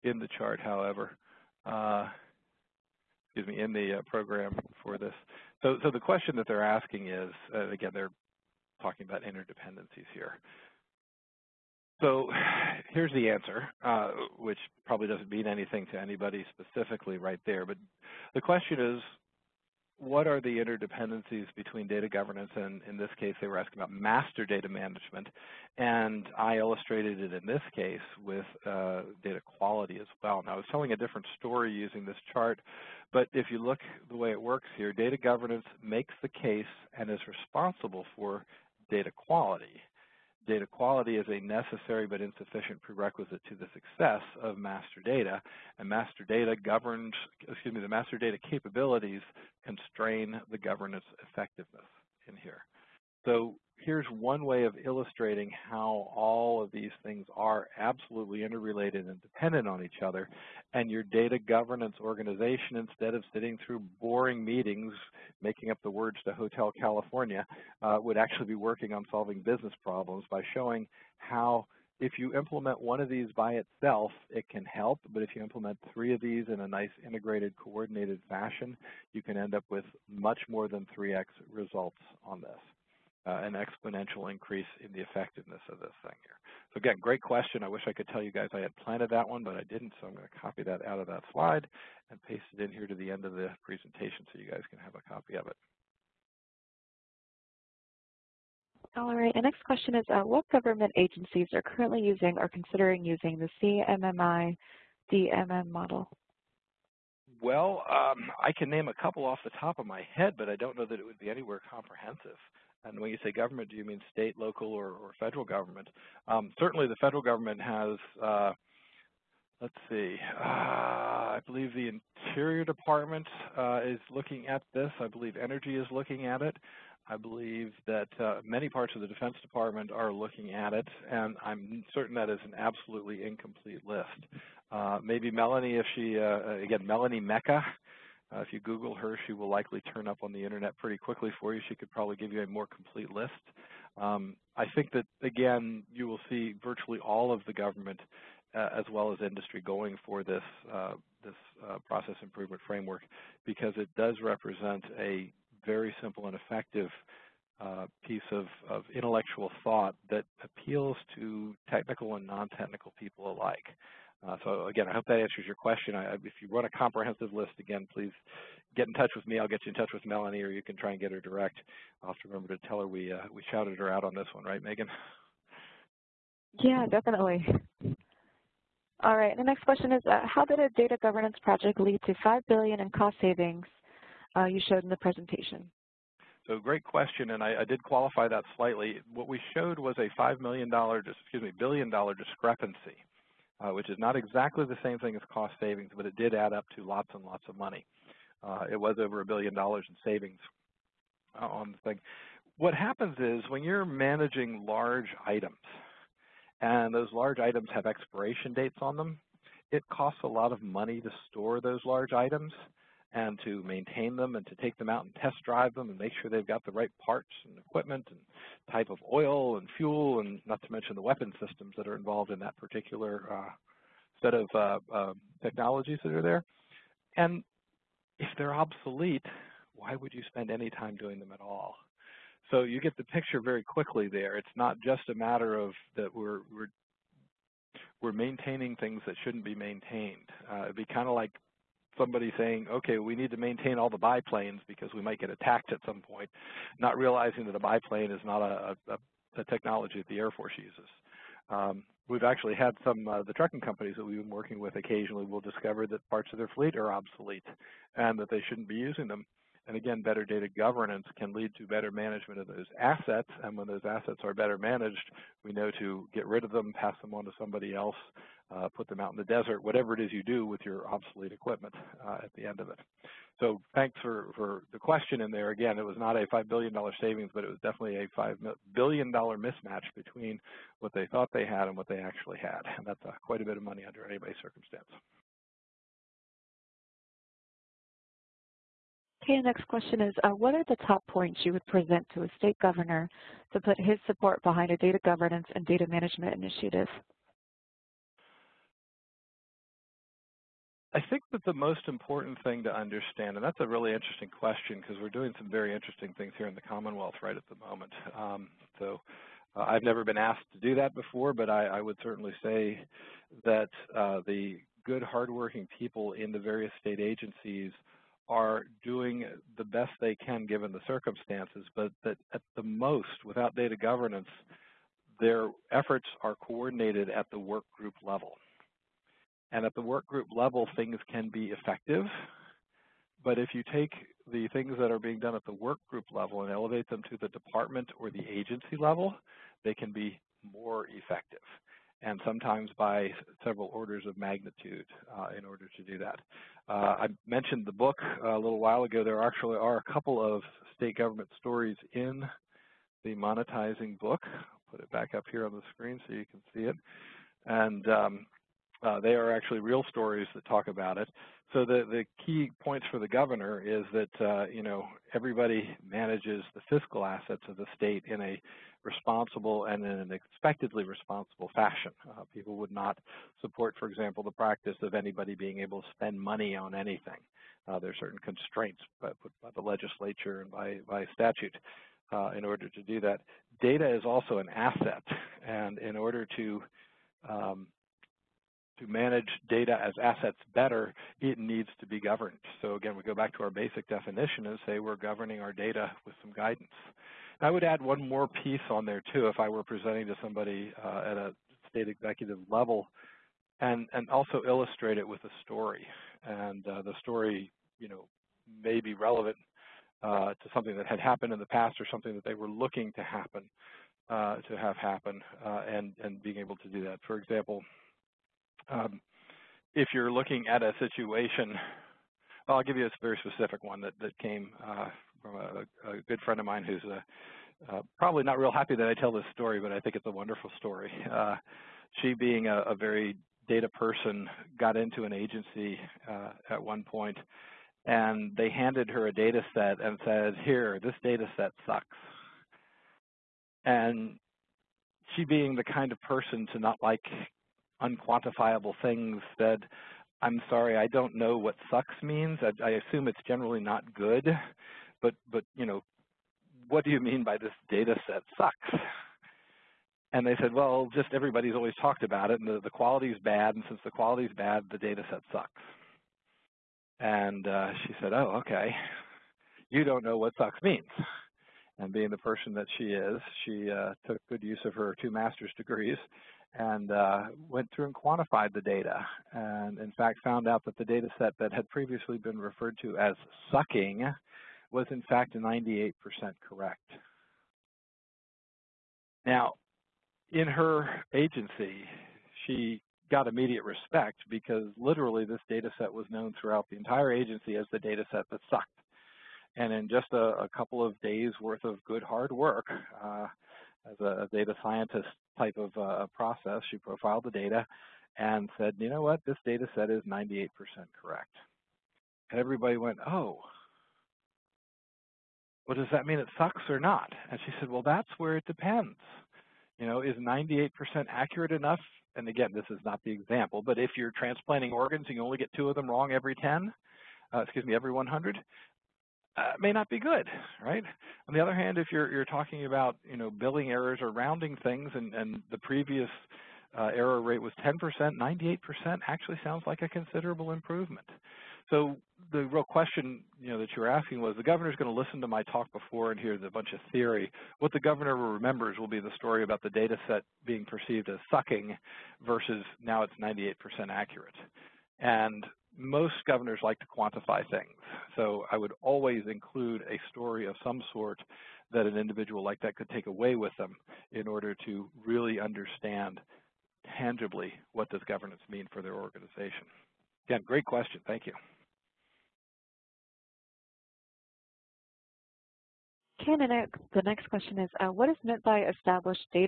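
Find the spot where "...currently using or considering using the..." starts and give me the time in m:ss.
1:41.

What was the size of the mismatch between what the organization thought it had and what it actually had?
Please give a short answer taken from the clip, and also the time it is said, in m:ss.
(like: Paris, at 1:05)
$5 billion, at 4:38.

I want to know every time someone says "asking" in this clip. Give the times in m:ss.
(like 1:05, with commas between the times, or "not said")
0:06, 0:23, 9:03.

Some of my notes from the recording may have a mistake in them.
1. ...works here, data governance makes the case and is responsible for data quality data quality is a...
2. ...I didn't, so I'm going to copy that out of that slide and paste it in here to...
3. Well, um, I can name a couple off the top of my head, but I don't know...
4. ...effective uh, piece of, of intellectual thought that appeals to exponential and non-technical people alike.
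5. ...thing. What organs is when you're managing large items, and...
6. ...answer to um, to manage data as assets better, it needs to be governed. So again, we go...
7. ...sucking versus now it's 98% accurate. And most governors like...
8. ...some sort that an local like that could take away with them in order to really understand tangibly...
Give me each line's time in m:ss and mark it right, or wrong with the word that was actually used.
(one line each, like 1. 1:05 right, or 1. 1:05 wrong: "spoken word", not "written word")
1. 0:34 right
2. 1:29 right
3. 1:47 right
4. 2:36 wrong: "technical", not "exponential"
5. 3:21 wrong: "happens", not "organs"
6. 6:25 wrong: "order", not "answer"
7. 9:11 right
8. 9:20 wrong: "individual", not "local".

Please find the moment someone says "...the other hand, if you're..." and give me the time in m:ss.
8:51.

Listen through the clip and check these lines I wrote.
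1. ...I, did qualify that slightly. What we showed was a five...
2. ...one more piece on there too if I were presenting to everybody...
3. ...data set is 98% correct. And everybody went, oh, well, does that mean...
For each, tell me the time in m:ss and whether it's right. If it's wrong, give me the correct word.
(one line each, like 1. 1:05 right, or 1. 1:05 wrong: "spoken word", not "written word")
1. 3:07 right
2. 6:37 wrong: "somebody", not "everybody"
3. 8:29 right.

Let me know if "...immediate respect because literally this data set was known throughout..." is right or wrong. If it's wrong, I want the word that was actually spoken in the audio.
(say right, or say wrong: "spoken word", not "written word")
right.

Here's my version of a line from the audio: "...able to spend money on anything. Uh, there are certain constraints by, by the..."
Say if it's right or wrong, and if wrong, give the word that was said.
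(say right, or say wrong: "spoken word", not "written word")
right.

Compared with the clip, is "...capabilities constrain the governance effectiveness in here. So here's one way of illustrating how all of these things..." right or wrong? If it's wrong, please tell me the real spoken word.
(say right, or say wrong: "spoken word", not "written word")
right.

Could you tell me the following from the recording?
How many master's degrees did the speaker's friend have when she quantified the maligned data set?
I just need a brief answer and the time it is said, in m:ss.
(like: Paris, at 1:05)
2, at 7:55.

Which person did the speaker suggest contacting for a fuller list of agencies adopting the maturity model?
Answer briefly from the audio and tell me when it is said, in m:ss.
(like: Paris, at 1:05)
Melanie Mecca, at 2:16.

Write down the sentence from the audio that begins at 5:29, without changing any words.
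And at the work group level, things can be effective.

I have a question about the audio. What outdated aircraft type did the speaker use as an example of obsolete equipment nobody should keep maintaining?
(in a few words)
biplane.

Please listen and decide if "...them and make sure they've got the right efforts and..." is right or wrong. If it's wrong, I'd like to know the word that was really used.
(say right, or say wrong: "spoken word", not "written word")
wrong: "parts", not "efforts".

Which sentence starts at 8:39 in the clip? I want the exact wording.
You know, is 98% accurate enough?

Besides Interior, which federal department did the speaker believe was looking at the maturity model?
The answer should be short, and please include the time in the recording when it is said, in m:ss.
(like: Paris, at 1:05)
Energy, at 2:05.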